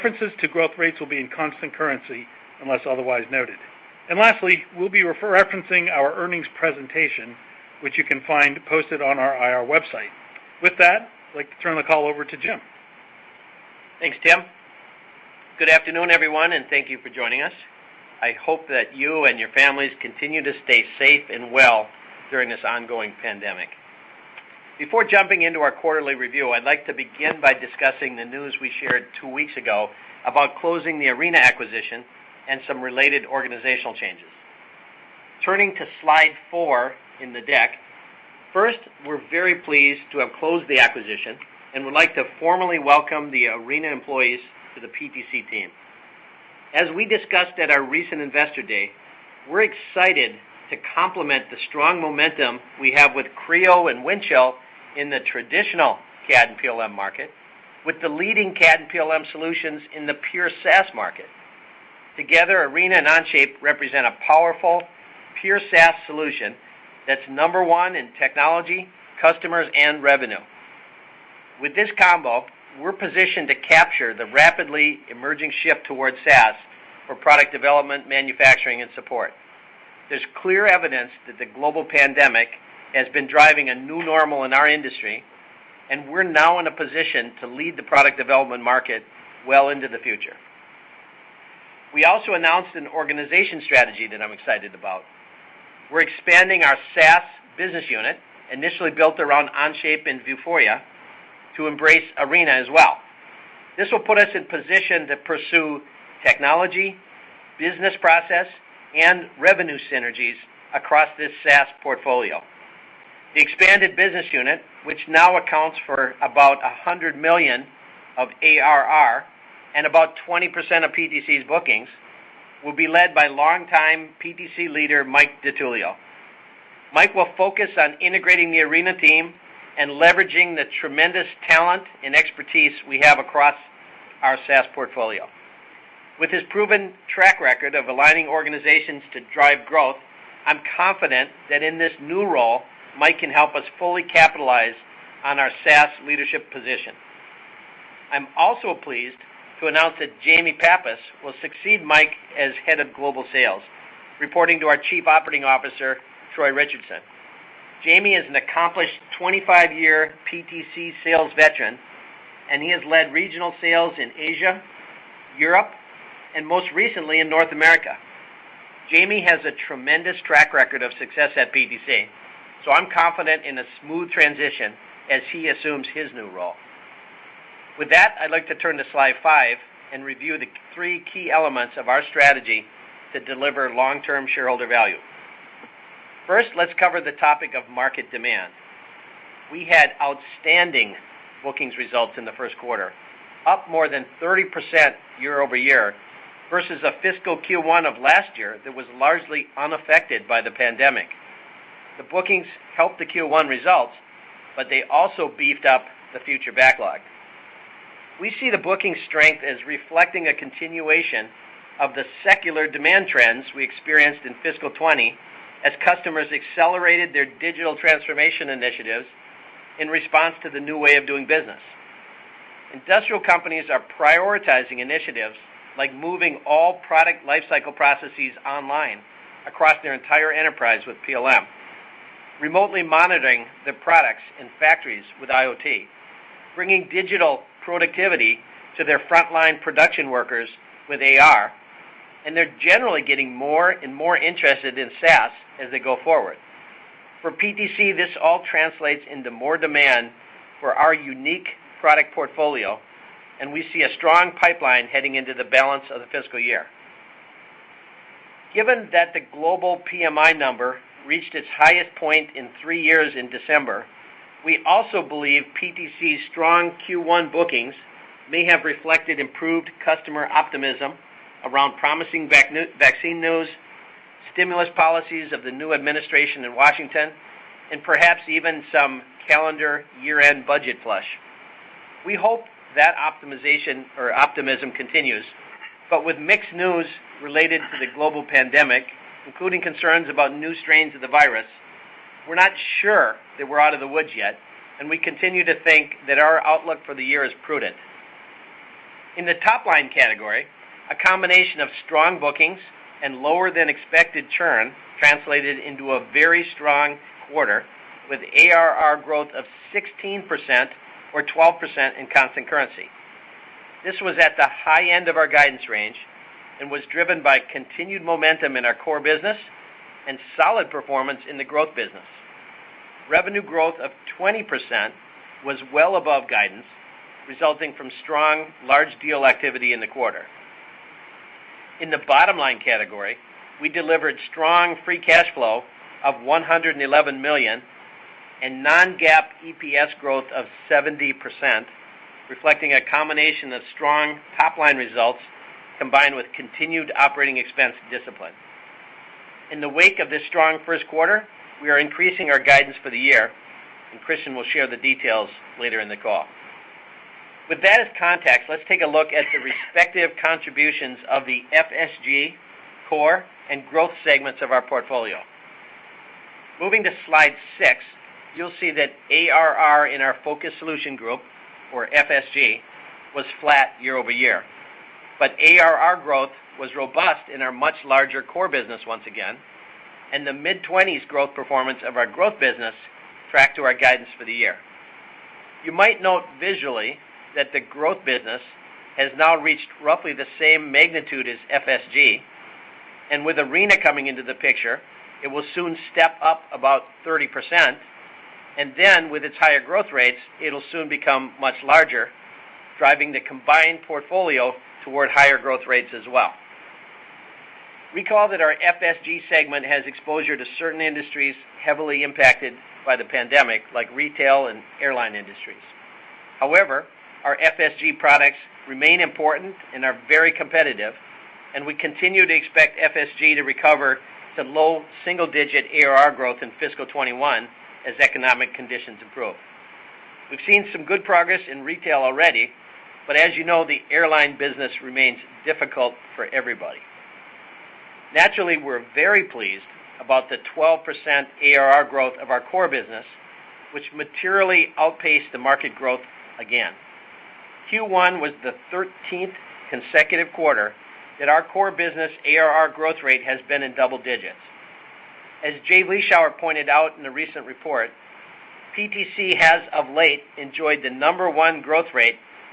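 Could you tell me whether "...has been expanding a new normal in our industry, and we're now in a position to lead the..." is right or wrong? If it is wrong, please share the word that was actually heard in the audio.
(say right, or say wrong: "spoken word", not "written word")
wrong: "driving", not "expanding".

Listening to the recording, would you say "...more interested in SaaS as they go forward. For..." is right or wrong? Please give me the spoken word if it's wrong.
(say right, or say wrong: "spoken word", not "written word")
right.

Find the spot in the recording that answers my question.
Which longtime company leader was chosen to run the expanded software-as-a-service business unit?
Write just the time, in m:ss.
2:05.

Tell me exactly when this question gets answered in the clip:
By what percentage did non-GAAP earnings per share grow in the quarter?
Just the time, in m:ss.
5:40.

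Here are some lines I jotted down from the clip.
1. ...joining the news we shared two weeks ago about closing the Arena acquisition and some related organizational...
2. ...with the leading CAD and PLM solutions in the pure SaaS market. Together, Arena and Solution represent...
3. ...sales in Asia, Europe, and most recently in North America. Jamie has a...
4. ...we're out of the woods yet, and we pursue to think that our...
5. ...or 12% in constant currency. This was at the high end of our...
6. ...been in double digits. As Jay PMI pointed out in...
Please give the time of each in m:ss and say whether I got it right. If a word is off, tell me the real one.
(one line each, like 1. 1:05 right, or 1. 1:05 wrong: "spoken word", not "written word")
1. 0:27 wrong: "discussing", not "joining"
2. 0:57 wrong: "Onshape", not "Solution"
3. 2:43 right
4. 4:53 wrong: "continue", not "pursue"
5. 5:11 right
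6. 7:33 wrong: "Vleeschhouwer", not "PMI".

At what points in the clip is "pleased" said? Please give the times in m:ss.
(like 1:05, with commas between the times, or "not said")
0:39, 2:28, 7:19.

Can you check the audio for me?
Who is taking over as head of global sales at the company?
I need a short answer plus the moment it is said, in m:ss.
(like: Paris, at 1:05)
Jamie Pappas, at 2:30.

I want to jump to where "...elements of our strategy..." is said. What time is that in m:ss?
3:01.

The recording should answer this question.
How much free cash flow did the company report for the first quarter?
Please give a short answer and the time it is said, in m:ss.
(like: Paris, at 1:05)
$111 million, at 5:36.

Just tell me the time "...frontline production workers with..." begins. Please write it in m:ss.
3:58.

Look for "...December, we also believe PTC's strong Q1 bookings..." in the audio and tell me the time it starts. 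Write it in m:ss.
4:23.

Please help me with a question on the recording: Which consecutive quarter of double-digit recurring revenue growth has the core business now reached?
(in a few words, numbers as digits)
13th.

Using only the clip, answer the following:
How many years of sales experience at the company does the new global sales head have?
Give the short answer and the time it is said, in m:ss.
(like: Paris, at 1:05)
25-year, at 2:39.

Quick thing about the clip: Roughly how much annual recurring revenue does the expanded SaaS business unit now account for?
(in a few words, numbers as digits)
$100 million.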